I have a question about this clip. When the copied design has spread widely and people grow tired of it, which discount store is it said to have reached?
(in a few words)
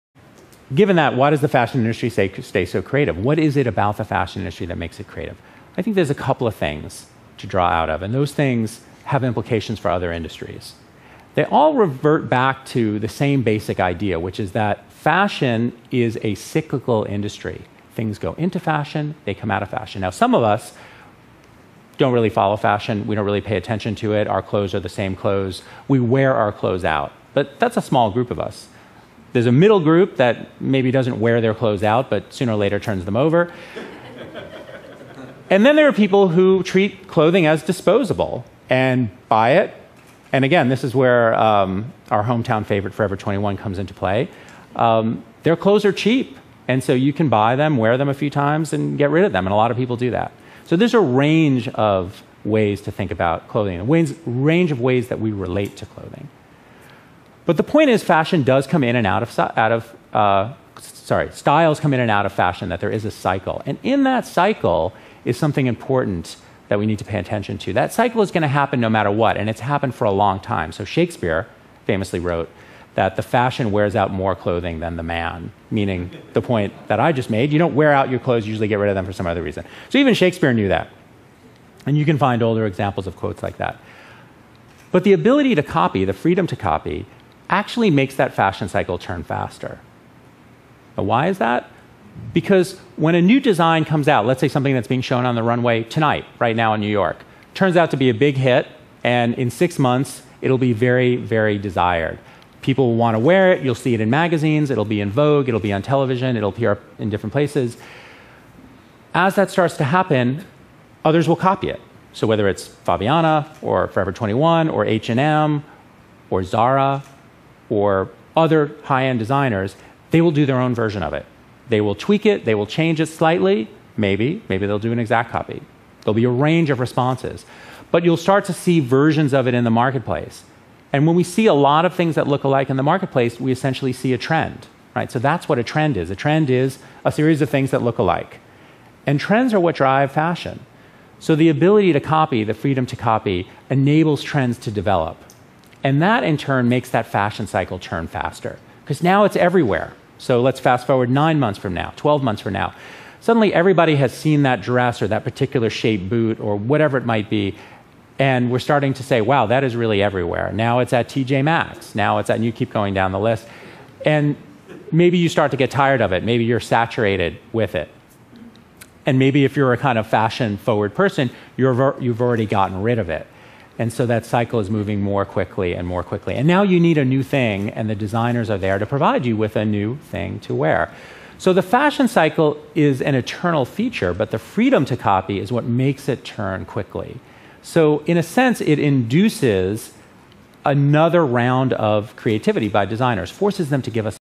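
TJ Maxx.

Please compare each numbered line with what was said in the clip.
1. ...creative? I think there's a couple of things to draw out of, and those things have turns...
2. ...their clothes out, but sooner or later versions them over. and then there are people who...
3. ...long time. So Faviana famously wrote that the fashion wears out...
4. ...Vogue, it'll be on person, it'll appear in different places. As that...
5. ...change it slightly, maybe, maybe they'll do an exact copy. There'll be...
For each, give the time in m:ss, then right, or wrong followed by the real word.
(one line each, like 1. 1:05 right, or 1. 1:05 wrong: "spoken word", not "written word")
1. 0:05 wrong: "implications", not "turns"
2. 0:31 wrong: "turns", not "versions"
3. 1:10 wrong: "Shakespeare", not "Faviana"
4. 1:45 wrong: "television", not "person"
5. 2:02 right.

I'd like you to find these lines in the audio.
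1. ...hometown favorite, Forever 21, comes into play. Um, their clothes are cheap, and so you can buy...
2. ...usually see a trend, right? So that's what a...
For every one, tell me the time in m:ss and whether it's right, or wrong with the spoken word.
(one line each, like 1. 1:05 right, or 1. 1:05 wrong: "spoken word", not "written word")
1. 0:42 right
2. 2:13 wrong: "essentially", not "usually".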